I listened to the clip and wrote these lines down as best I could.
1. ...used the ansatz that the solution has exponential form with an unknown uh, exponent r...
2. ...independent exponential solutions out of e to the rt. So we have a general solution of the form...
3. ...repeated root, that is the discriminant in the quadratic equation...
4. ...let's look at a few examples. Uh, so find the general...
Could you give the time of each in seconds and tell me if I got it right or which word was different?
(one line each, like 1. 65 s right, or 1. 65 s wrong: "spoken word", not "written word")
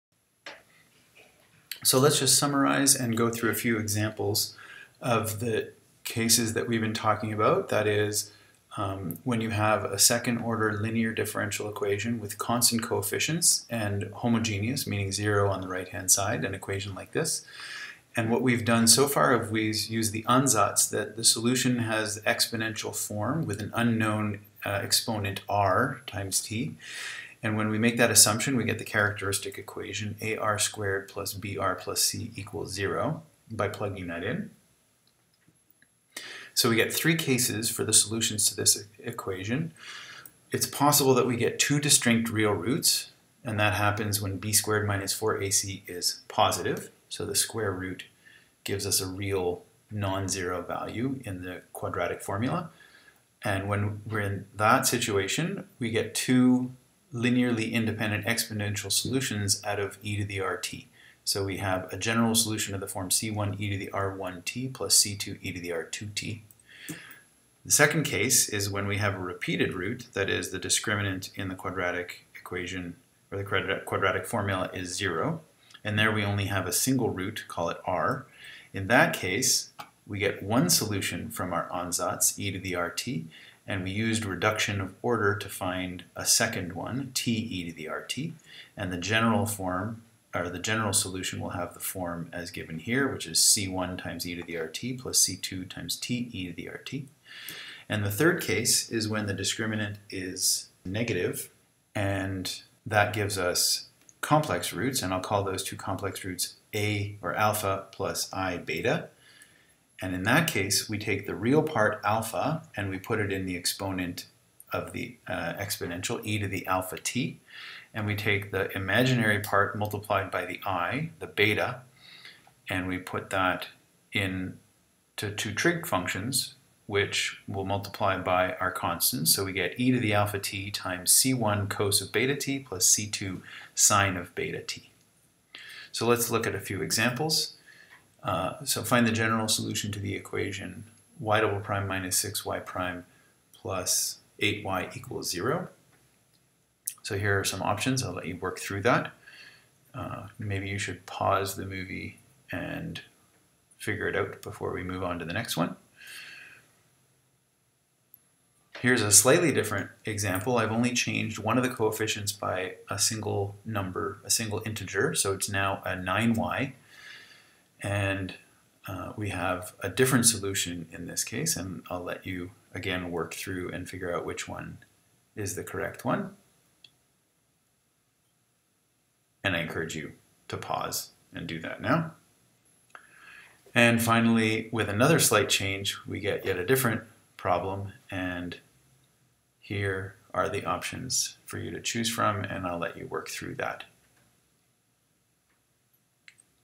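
1. 19 s right
2. 57 s right
3. 69 s right
4. 136 s right.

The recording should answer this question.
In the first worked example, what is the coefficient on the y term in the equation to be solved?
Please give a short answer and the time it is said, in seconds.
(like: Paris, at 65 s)
8, at 144 s.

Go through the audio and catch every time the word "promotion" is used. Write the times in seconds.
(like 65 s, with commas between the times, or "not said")
not said.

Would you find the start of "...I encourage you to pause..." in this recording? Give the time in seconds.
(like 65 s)
179 s.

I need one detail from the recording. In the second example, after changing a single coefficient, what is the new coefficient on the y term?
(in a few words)
9.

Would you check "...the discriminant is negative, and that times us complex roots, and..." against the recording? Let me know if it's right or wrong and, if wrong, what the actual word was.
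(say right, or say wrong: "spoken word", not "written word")
wrong: "gives", not "times".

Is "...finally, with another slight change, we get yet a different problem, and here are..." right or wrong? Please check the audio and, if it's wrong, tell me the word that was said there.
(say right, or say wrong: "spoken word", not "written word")
right.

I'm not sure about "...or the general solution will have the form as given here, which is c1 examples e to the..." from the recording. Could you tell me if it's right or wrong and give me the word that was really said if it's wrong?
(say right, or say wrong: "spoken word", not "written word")
wrong: "times", not "examples".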